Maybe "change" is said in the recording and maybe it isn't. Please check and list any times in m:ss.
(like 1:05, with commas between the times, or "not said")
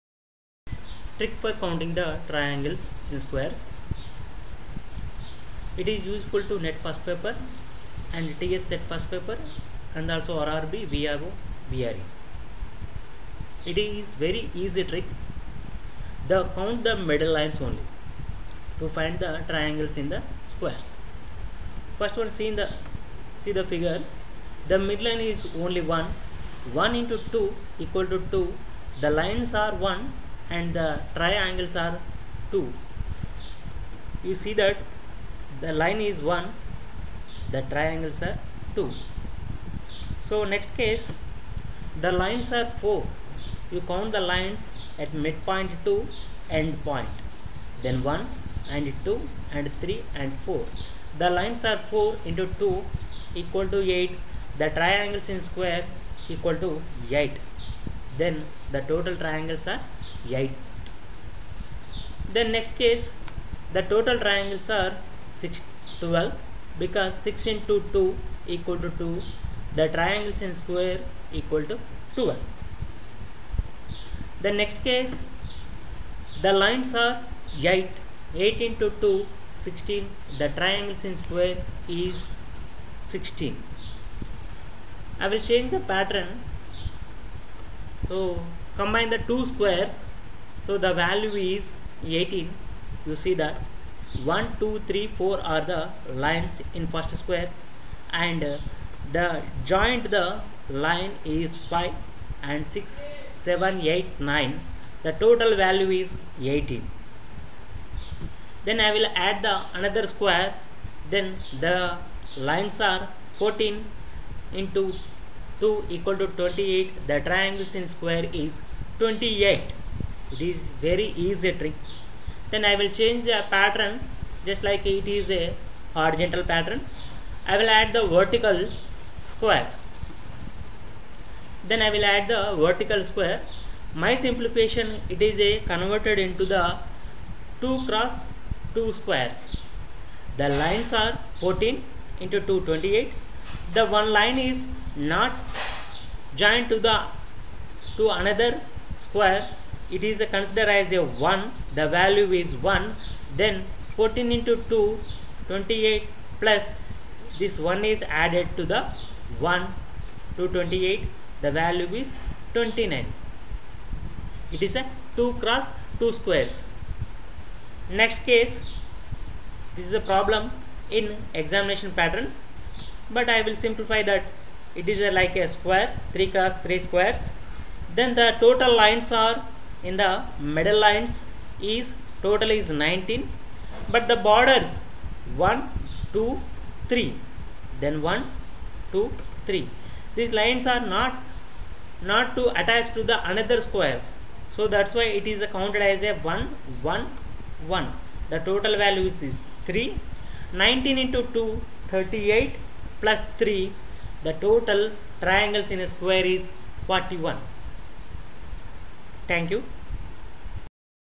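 1:25, 2:02.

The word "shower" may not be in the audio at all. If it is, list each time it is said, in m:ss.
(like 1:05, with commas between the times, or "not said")
not said.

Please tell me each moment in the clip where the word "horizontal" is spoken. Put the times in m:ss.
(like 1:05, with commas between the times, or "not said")
2:05.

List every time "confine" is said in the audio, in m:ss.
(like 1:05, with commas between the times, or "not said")
not said.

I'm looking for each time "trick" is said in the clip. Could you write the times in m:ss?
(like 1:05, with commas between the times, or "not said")
0:01, 0:14, 2:01.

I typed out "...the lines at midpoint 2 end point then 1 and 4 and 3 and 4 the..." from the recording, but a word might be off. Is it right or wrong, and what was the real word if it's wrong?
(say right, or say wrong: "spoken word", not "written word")
wrong: "2", not "4".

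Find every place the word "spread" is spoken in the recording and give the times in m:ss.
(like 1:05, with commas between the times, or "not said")
not said.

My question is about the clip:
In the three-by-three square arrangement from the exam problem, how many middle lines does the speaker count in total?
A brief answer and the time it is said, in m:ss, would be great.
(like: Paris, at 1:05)
19, at 3:02.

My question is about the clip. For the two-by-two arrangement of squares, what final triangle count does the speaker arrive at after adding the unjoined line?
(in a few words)
29.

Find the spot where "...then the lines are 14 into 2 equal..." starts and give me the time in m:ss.
1:51.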